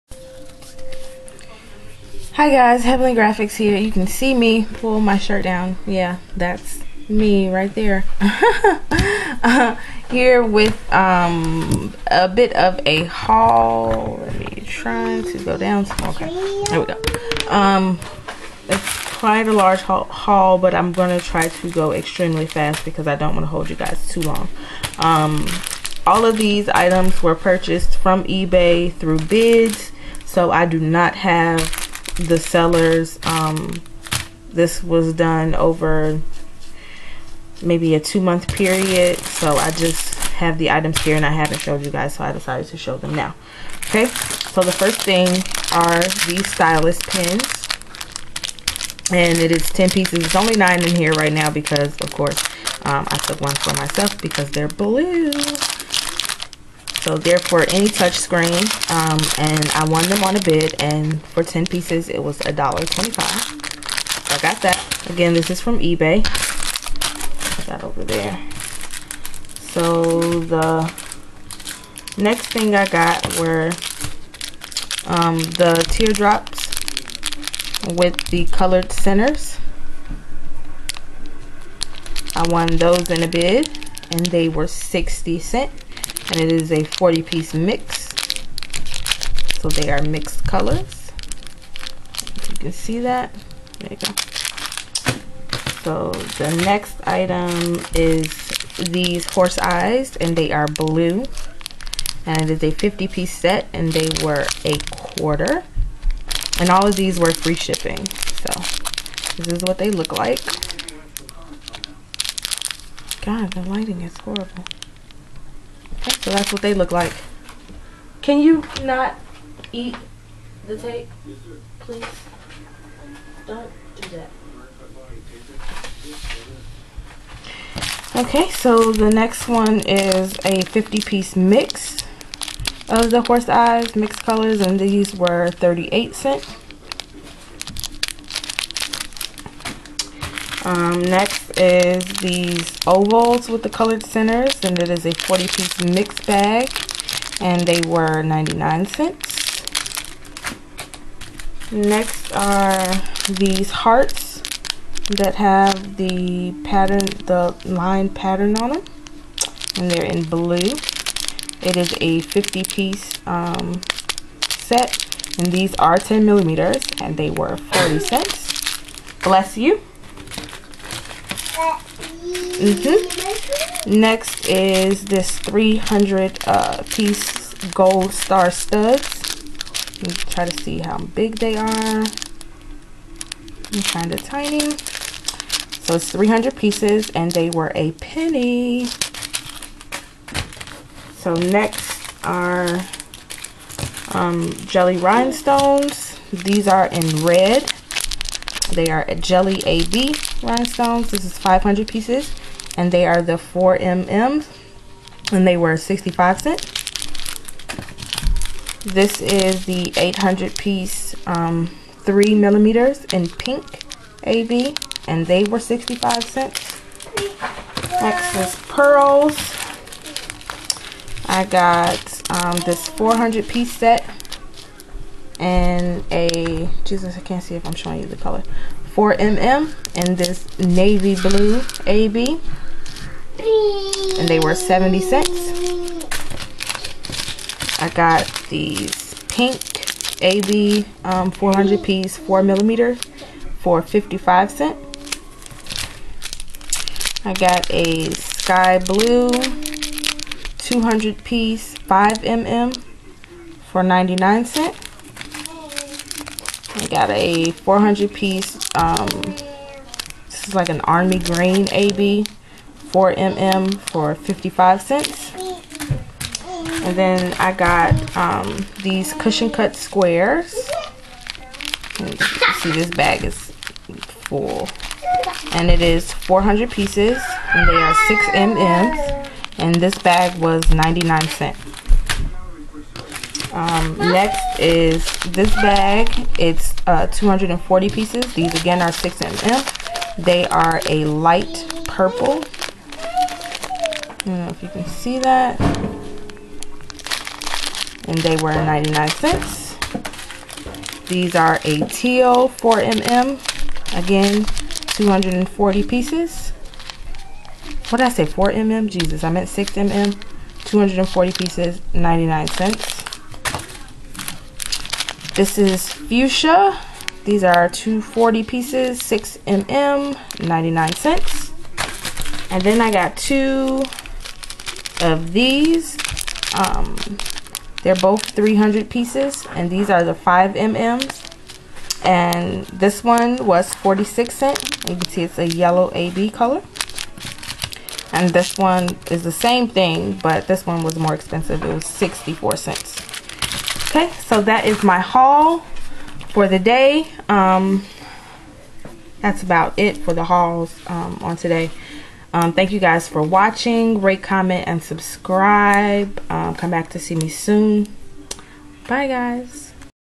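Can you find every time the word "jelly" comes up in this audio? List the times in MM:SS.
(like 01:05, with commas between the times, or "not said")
03:14, 03:19.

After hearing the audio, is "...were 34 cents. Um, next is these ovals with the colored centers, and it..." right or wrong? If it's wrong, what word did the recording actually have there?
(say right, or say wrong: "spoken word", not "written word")
wrong: "38", not "34".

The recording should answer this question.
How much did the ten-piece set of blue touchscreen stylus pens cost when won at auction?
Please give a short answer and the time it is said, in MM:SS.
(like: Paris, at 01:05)
$1.25, at 01:02.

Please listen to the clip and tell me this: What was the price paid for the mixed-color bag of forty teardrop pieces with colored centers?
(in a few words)
60 cents.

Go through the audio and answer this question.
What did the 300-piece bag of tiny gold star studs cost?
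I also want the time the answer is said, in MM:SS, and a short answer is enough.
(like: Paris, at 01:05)
a penny, at 03:07.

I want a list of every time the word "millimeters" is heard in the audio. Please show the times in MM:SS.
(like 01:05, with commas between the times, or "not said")
02:46, 03:32, 04:02.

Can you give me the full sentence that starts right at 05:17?
These are 240 pieces, 6 mm, 99 cents.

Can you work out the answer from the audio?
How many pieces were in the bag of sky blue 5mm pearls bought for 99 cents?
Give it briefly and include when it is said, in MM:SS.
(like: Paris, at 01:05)
200, at 04:10.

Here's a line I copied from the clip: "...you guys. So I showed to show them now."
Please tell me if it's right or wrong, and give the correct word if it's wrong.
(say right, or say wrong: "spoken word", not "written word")
wrong: "decided", not "showed".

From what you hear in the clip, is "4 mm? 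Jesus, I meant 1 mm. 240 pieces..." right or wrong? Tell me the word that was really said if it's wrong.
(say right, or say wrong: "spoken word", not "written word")
wrong: "6", not "1".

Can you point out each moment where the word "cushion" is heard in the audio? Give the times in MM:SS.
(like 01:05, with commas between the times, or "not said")
04:29.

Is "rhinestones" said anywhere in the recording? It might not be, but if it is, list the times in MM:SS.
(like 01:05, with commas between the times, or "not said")
03:14, 03:20.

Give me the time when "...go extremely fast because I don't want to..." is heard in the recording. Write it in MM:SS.
00:21.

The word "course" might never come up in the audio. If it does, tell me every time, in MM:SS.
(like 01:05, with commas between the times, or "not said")
00:52.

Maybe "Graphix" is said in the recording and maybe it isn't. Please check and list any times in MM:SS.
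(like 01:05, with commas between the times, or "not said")
00:03.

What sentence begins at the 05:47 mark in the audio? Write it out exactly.
Um, that's about it for the hauls um, on today.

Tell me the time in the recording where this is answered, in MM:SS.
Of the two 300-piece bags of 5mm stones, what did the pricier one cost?
05:41.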